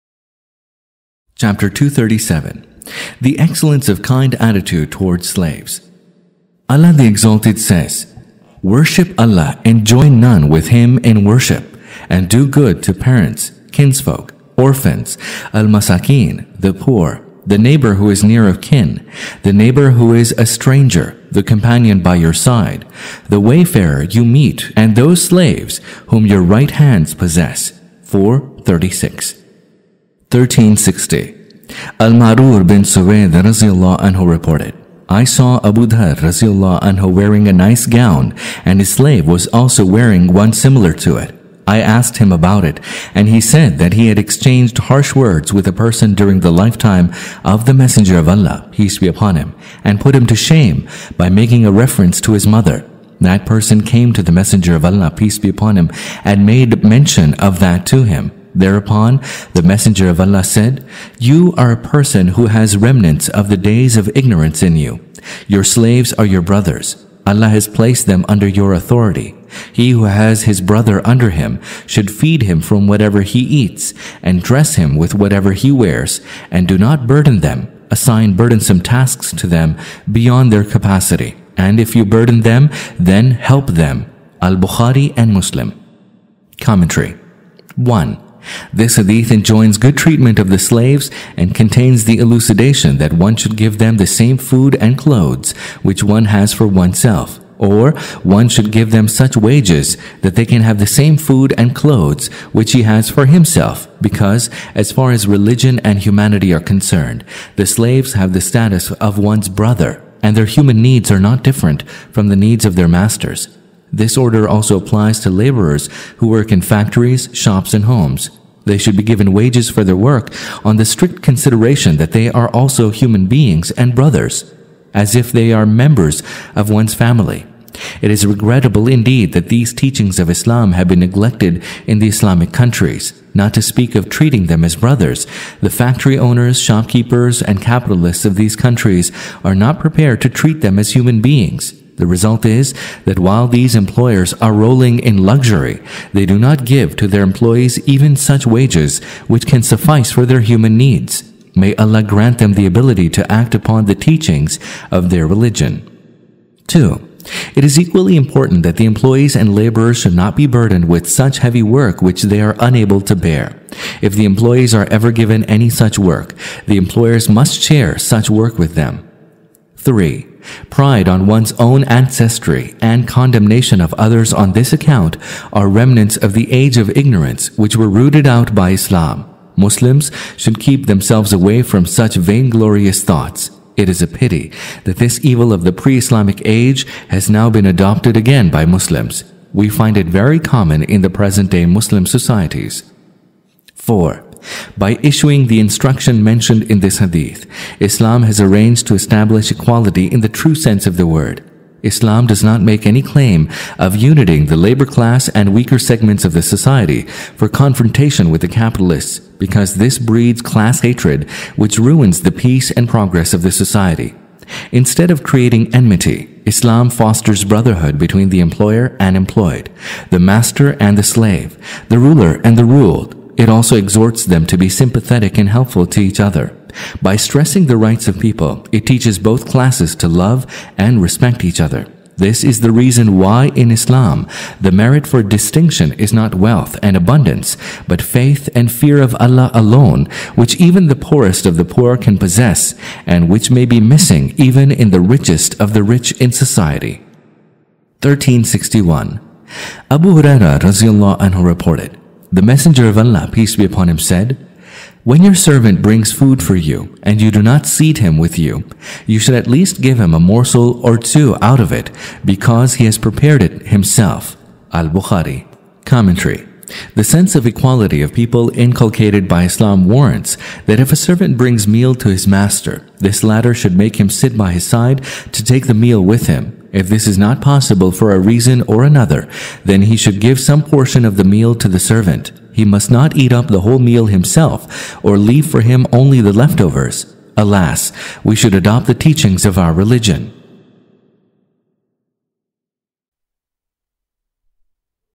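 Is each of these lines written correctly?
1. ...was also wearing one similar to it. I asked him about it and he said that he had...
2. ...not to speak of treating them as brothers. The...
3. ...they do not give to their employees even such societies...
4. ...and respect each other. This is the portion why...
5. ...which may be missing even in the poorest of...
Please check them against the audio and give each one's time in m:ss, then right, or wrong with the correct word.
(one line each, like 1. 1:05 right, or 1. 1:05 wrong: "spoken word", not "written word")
1. 0:39 right
2. 2:13 right
3. 2:26 wrong: "wages", not "societies"
4. 3:50 wrong: "reason", not "portion"
5. 4:03 wrong: "richest", not "poorest".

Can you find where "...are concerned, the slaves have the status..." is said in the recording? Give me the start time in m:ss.
1:46.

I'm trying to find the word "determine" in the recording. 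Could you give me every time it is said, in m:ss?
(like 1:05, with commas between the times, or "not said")
not said.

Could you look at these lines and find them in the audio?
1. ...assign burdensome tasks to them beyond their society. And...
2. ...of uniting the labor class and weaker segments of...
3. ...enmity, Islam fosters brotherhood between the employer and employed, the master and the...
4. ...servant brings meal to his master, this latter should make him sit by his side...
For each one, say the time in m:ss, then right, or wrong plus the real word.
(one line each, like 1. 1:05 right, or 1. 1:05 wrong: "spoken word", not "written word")
1. 1:17 wrong: "capacity", not "society"
2. 3:23 right
3. 3:35 right
4. 4:30 right.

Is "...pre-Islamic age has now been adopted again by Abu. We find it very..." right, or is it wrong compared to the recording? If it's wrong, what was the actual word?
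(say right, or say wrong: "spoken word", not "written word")
wrong: "Muslims", not "Abu".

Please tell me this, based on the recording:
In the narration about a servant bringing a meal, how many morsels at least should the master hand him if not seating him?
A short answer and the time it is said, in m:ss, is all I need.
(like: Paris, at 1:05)
2, at 4:20.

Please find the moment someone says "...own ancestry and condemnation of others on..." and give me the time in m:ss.
2:51.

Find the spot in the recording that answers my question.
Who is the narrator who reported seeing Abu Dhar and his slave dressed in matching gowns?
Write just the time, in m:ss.
0:31.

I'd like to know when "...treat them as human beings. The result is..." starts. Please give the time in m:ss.
2:20.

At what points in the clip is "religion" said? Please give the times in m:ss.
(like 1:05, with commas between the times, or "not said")
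1:45, 2:35, 4:49.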